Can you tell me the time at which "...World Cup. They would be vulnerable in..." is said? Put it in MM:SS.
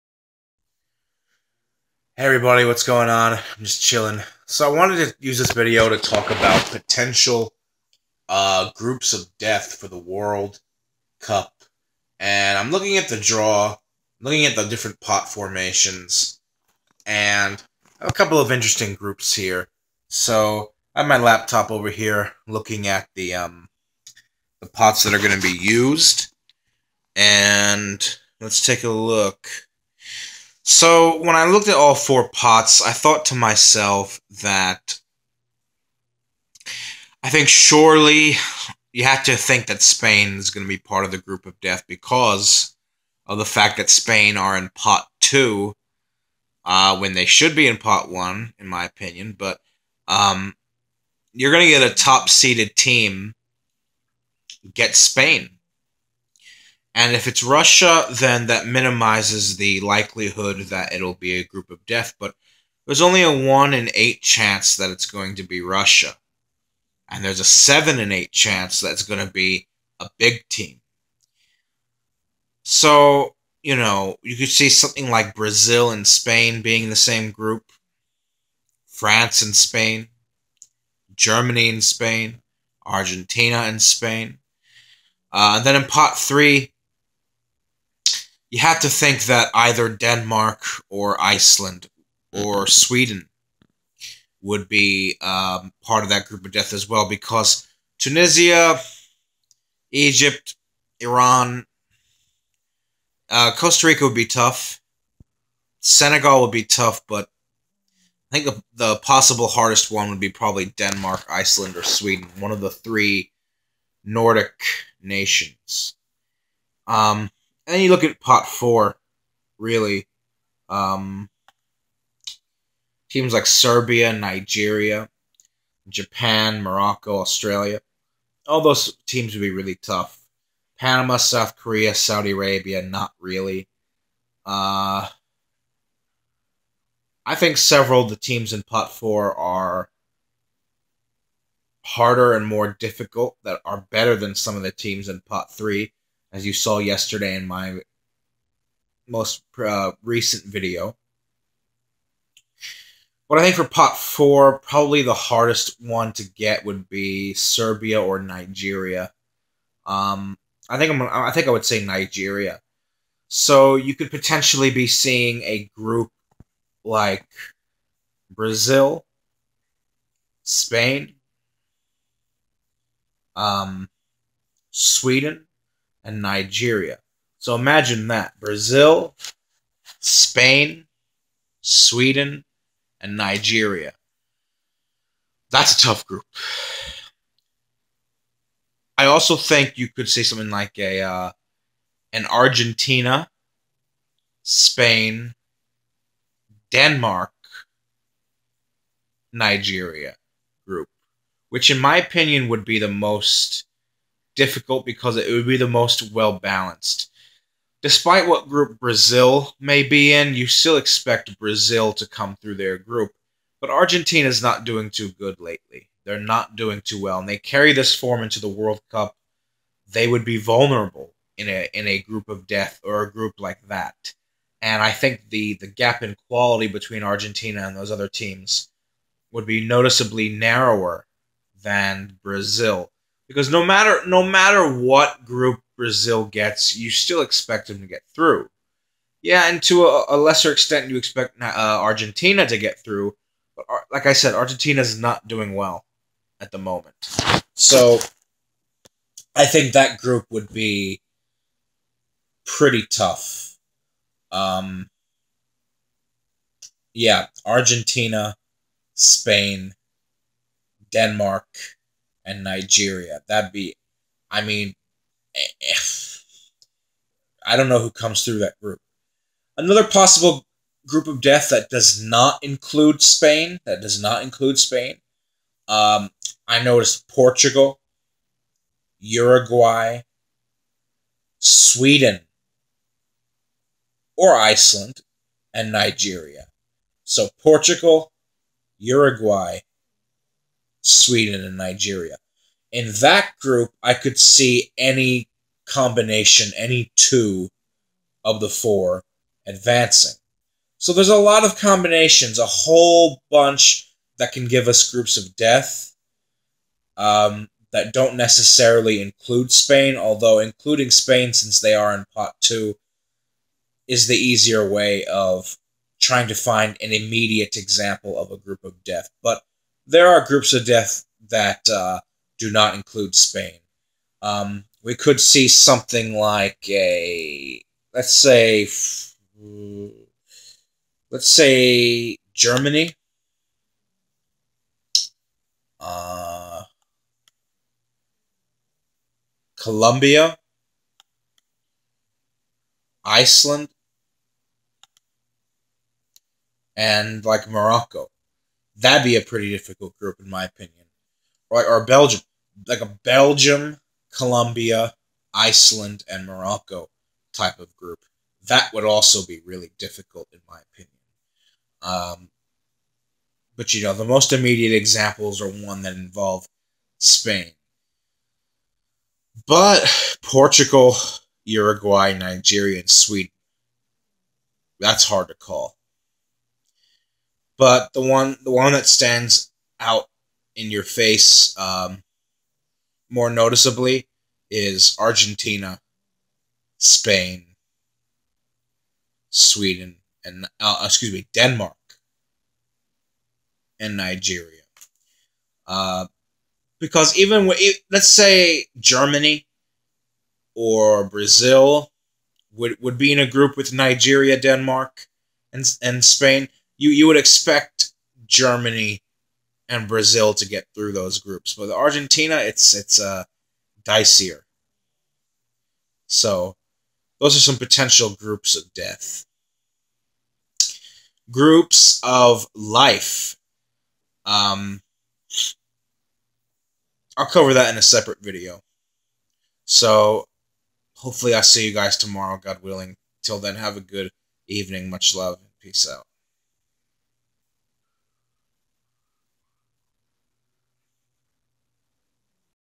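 03:38.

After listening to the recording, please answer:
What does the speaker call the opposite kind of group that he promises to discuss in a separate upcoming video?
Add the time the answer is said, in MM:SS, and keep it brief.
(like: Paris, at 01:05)
Groups of life, at 07:01.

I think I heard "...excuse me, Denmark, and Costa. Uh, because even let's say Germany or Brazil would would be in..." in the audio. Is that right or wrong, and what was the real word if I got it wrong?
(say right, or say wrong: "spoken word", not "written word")
wrong: "Nigeria", not "Costa".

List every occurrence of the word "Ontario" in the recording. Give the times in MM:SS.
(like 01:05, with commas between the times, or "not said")
not said.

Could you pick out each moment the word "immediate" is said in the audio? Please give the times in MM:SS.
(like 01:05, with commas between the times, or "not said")
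05:16, 06:04.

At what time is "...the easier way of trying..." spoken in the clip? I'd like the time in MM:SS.
05:14.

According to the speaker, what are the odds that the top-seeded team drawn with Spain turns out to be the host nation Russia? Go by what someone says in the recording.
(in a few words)
1 in 8.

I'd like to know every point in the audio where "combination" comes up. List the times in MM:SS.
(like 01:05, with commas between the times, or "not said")
04:55, 05:01.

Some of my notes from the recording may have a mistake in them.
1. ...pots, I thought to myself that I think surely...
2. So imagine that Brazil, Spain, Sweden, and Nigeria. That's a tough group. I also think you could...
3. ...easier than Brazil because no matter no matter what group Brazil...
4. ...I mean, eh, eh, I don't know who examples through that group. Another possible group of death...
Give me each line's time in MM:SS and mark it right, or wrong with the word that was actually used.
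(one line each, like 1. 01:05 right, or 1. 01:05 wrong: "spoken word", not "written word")
1. 00:32 right
2. 02:57 right
3. 03:50 wrong: "narrower", not "easier"
4. 04:24 wrong: "comes", not "examples".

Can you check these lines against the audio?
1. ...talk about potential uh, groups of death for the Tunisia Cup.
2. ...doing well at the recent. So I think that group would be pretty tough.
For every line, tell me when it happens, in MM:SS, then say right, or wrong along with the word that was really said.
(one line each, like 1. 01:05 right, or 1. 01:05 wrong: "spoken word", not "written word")
1. 00:05 wrong: "World", not "Tunisia"
2. 04:05 wrong: "moment", not "recent".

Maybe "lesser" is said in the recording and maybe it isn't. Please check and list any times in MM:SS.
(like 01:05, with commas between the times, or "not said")
04:00.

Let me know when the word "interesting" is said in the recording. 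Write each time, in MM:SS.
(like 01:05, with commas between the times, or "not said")
00:18.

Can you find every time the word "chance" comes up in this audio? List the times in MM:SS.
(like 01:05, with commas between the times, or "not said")
01:04, 01:08.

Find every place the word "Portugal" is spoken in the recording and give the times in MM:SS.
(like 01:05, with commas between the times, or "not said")
04:37, 04:47, 06:10.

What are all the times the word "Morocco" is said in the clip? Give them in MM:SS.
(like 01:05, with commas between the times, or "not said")
02:06, 05:47, 05:56.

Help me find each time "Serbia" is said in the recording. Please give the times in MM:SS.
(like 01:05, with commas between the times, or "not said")
02:03, 02:37.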